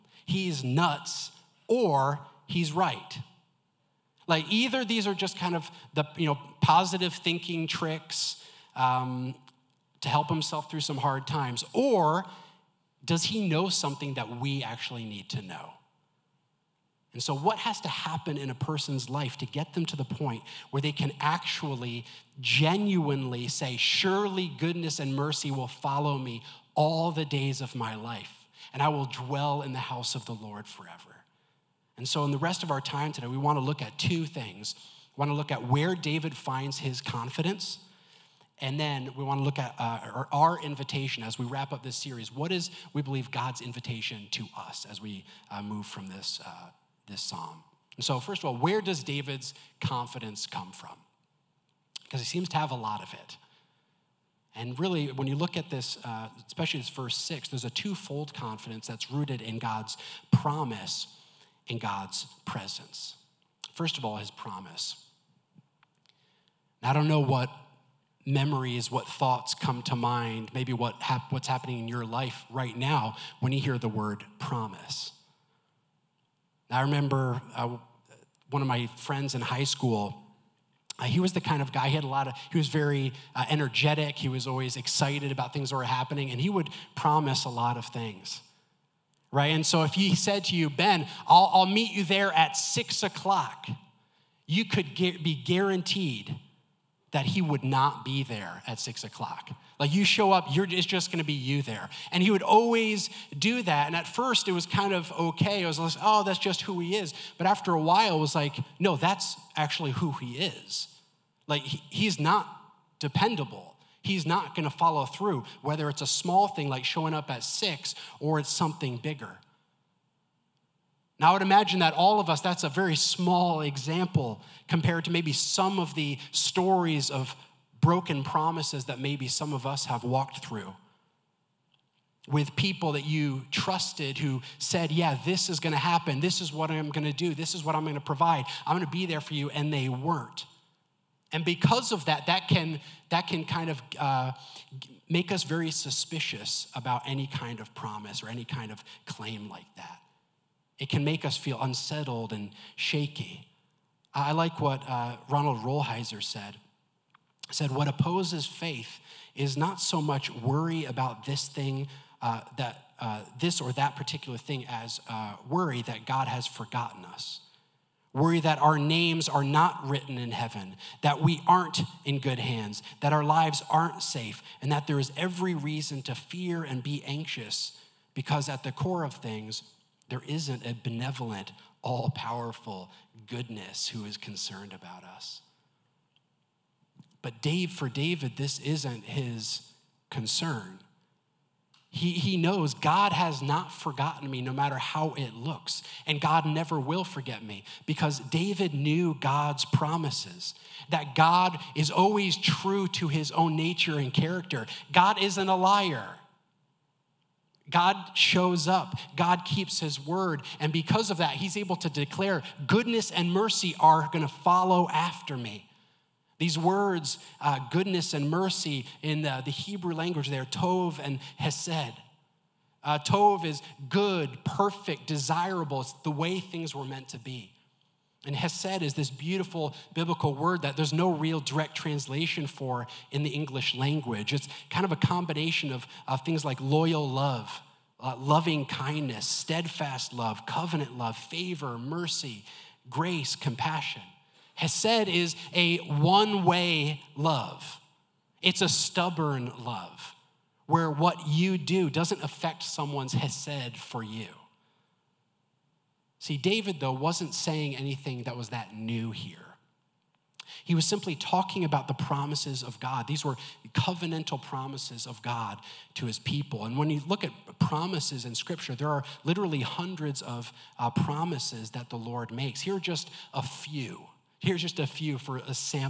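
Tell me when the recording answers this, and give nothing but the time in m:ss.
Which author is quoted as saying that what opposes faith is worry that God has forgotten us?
2:35.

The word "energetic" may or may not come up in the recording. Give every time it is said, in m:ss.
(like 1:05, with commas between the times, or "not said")
1:23.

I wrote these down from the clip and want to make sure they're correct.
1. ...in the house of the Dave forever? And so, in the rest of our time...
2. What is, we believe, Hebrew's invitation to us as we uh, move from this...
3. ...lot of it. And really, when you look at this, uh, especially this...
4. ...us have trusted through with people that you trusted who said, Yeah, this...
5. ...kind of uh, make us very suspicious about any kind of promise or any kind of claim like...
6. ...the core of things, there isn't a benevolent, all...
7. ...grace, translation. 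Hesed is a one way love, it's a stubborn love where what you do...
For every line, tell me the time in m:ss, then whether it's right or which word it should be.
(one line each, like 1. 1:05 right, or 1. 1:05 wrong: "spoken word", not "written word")
1. 0:29 wrong: "Lord", not "Dave"
2. 0:42 wrong: "God", not "Hebrew"
3. 0:52 right
4. 2:09 wrong: "walked", not "trusted"
5. 2:23 right
6. 2:58 right
7. 4:02 wrong: "compassion", not "translation".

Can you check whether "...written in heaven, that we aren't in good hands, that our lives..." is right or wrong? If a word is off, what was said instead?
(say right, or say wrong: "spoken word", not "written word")
right.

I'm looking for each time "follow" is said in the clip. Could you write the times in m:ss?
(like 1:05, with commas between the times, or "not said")
0:25, 1:54, 3:34.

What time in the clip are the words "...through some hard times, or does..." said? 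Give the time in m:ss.
0:10.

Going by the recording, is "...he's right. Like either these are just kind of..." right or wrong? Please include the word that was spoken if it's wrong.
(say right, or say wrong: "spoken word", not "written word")
right.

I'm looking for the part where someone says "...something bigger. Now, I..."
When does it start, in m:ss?
1:58.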